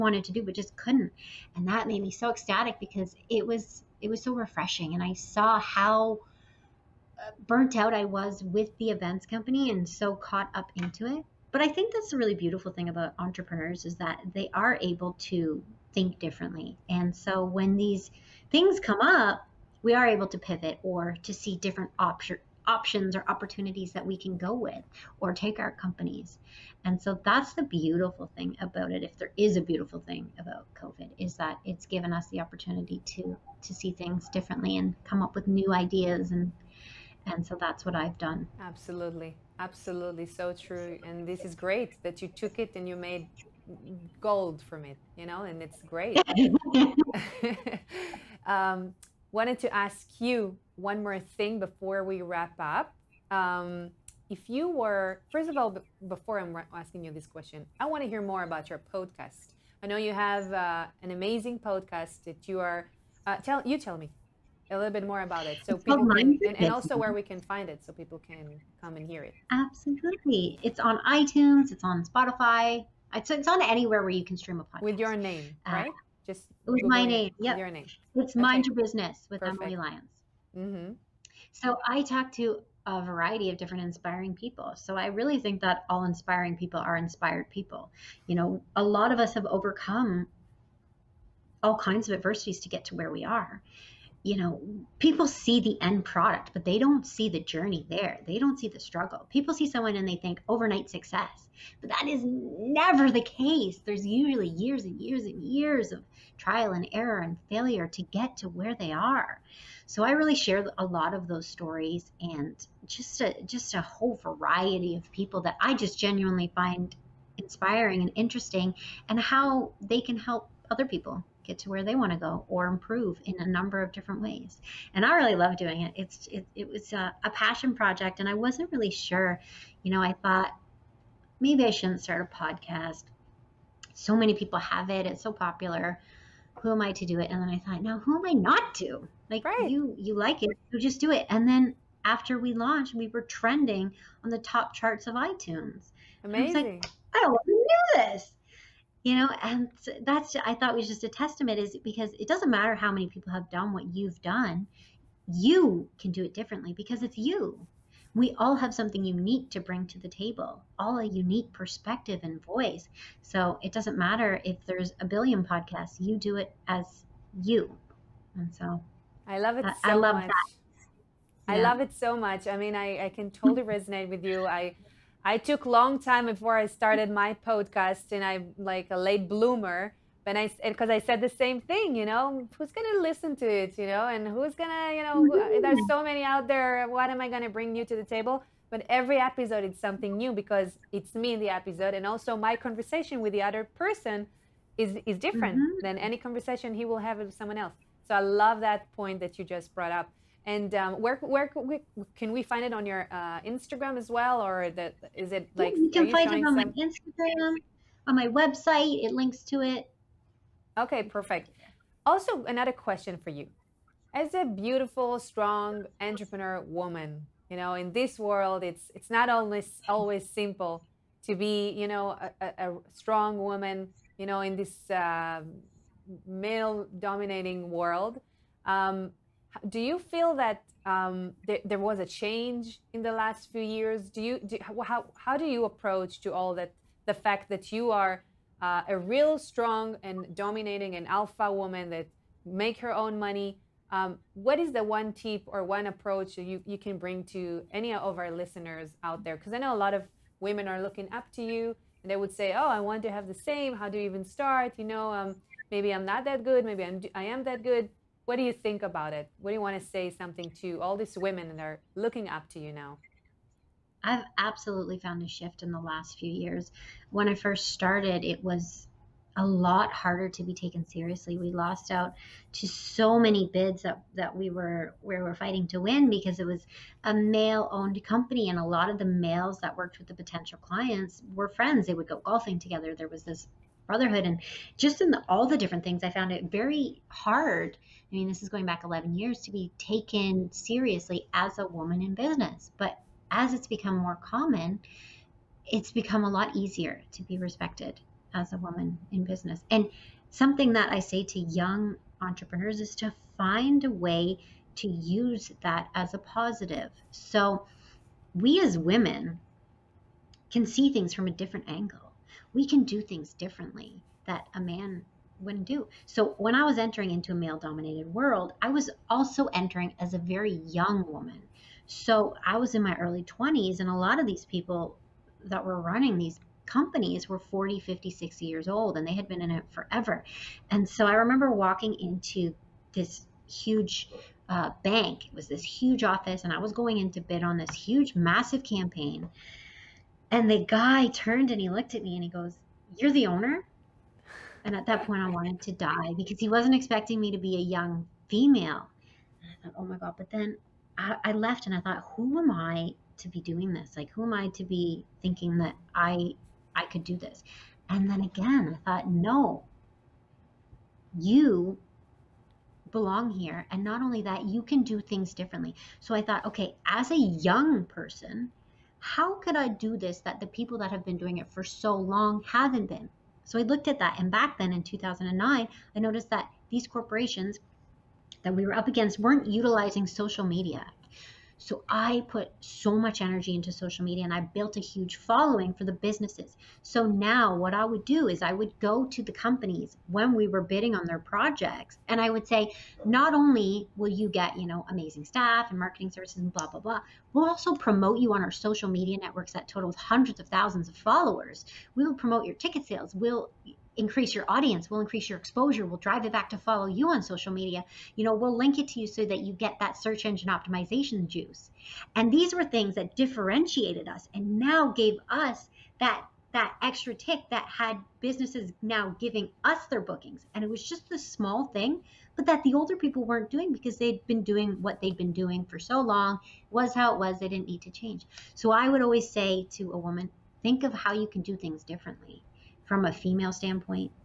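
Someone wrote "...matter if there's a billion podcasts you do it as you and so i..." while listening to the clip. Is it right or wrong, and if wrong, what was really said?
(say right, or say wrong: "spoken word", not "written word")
right.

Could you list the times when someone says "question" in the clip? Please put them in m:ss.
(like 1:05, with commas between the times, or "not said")
0:57, 3:32.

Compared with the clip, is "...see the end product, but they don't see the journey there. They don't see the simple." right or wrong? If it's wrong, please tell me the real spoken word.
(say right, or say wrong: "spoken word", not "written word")
wrong: "struggle", not "simple".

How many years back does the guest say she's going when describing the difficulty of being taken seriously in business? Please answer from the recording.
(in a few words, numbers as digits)
11.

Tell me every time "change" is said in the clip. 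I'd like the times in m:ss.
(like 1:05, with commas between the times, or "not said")
3:52, 7:07.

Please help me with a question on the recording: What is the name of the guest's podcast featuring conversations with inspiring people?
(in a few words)
Mind Your Business.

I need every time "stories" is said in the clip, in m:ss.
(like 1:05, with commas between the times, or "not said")
1:51.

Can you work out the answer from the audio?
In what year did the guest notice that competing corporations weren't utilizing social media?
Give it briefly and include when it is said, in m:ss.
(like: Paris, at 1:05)
2009, at 6:14.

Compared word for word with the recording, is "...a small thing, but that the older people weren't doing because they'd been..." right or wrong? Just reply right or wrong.
right.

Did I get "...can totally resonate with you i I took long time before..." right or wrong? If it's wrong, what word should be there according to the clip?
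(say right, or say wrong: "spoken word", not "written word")
right.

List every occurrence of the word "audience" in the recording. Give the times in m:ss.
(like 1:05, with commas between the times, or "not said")
6:44.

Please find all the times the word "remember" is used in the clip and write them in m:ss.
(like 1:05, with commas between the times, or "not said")
5:31.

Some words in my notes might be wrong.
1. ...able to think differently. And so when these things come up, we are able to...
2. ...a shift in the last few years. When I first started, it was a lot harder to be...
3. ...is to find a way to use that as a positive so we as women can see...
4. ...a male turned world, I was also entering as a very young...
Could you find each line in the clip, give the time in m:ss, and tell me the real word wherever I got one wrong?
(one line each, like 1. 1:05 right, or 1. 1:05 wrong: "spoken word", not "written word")
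1. 0:14 right
2. 4:25 right
3. 5:02 right
4. 5:17 wrong: "dominated", not "turned".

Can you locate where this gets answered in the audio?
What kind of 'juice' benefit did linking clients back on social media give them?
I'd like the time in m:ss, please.
6:49.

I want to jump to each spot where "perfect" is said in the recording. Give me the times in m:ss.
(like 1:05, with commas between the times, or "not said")
1:19, 3:31.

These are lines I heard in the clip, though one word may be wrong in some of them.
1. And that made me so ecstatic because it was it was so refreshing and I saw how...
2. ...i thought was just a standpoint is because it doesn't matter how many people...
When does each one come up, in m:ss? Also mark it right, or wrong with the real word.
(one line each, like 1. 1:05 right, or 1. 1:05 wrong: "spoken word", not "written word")
1. 0:01 right
2. 2:30 wrong: "testament", not "standpoint".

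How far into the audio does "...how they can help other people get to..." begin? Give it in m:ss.
1:59.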